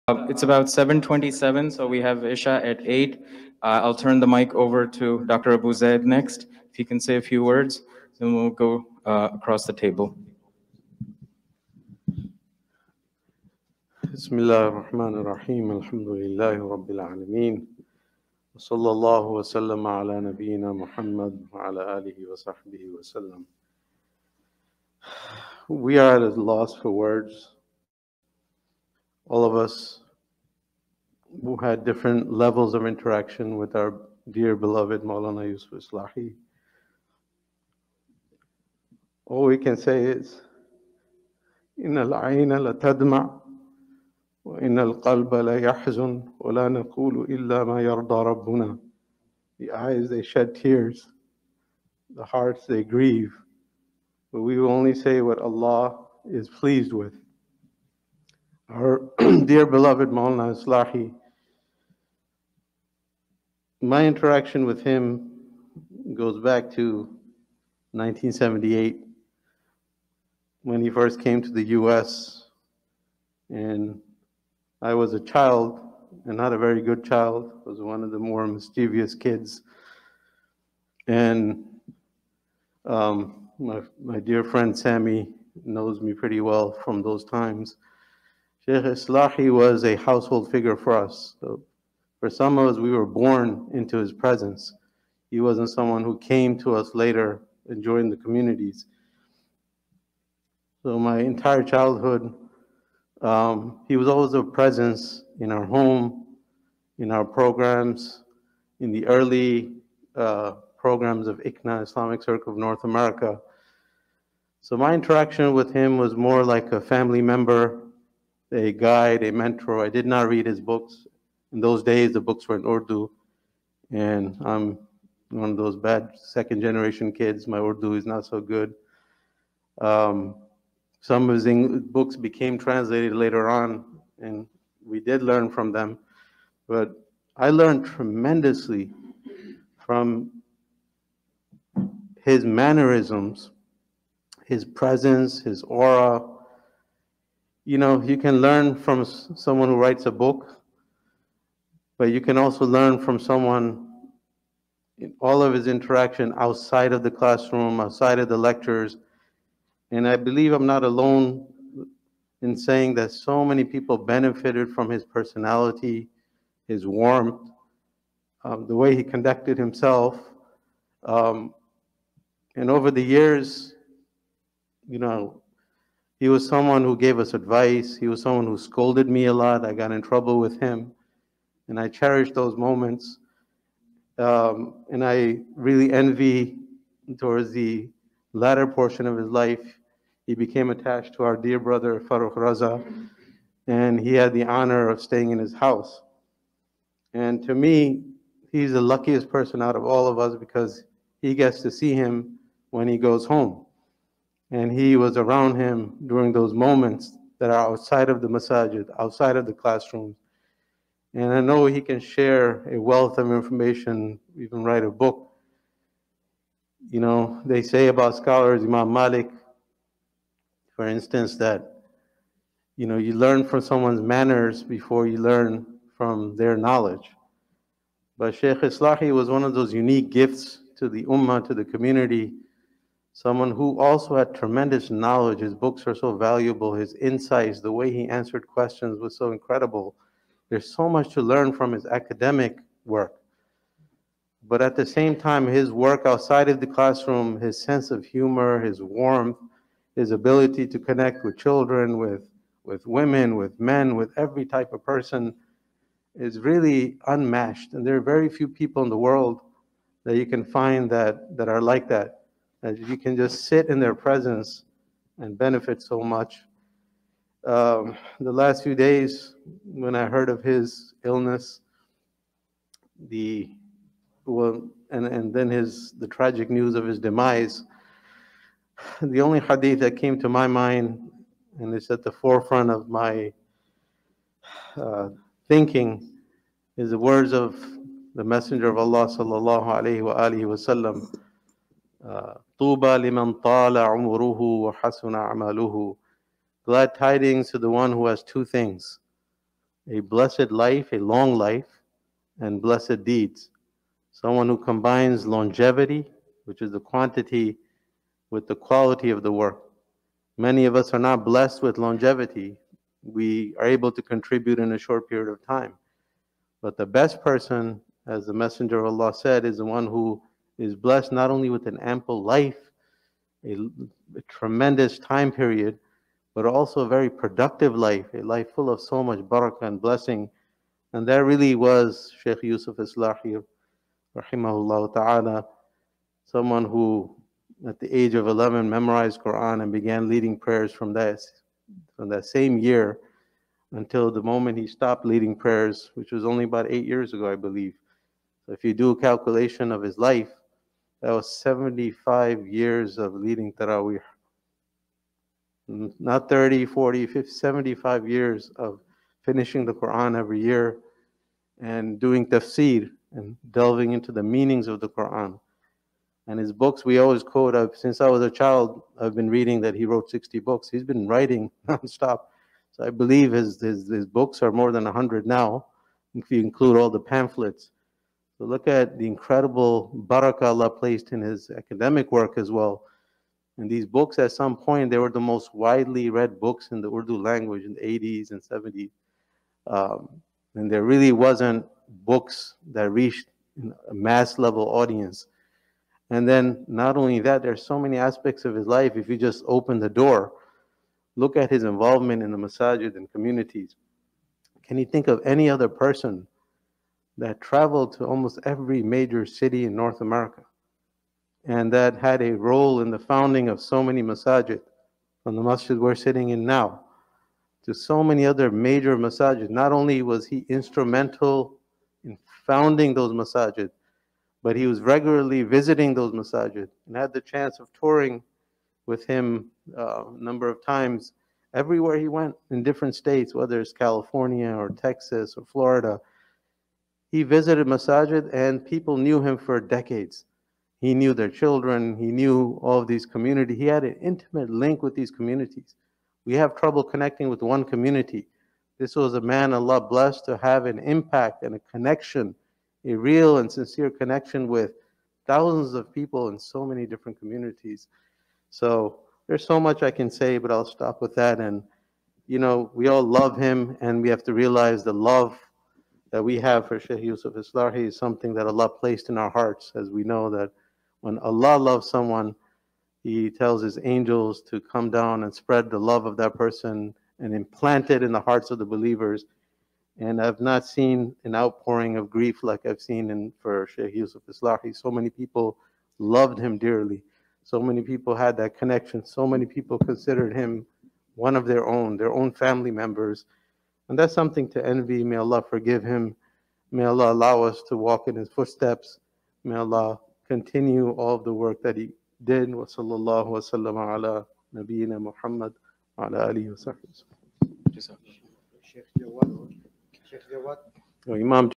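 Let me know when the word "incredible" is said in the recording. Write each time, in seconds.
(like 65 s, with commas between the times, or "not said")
239 s, 379 s.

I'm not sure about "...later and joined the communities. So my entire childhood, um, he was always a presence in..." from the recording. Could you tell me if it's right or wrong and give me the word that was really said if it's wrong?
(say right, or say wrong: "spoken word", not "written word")
right.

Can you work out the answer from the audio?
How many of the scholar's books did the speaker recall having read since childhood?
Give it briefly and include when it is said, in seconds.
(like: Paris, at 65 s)
60, at 370 s.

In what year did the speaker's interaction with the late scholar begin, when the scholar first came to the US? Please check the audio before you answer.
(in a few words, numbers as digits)
1978.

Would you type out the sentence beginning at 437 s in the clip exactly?
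He visited masajid and people knew him for decades.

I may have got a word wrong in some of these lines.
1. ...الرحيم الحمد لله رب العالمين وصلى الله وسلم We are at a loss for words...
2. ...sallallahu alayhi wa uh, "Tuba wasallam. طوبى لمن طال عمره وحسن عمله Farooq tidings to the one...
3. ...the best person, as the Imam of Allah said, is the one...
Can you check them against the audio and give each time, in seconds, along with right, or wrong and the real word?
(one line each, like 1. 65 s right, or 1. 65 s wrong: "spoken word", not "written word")
1. 15 s right
2. 289 s wrong: "Glad", not "Farooq"
3. 316 s wrong: "Messenger", not "Imam".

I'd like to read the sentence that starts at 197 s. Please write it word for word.
And to me, he's the luckiest person out of all of us because he gets to see him when he goes home.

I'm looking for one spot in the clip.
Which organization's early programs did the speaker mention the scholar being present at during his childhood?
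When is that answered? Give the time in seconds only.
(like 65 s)
111 s.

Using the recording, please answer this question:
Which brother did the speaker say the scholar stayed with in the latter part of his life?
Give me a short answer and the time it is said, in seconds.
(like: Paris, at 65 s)
Farooq Raza, at 192 s.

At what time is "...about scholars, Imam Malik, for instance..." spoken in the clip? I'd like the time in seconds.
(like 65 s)
217 s.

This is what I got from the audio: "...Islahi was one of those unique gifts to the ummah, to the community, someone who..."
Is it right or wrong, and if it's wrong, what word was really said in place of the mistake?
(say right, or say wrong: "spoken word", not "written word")
right.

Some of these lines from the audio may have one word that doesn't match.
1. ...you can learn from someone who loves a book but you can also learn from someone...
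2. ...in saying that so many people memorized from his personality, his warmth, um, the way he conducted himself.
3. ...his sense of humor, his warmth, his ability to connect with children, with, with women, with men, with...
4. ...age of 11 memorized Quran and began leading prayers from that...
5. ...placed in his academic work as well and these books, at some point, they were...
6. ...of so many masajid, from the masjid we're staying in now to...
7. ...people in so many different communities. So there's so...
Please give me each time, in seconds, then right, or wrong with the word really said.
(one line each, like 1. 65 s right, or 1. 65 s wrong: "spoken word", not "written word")
1. 148 s wrong: "writes", not "loves"
2. 162 s wrong: "benefited", not "memorized"
3. 247 s right
4. 337 s right
5. 380 s right
6. 413 s wrong: "sitting", not "staying"
7. 455 s right.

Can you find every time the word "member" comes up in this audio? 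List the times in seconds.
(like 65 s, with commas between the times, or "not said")
117 s, 492 s.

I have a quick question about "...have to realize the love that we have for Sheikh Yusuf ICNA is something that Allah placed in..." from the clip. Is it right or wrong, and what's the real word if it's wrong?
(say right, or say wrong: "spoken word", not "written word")
wrong: "Islahi", not "ICNA".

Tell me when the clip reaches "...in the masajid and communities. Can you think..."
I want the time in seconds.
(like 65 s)
402 s.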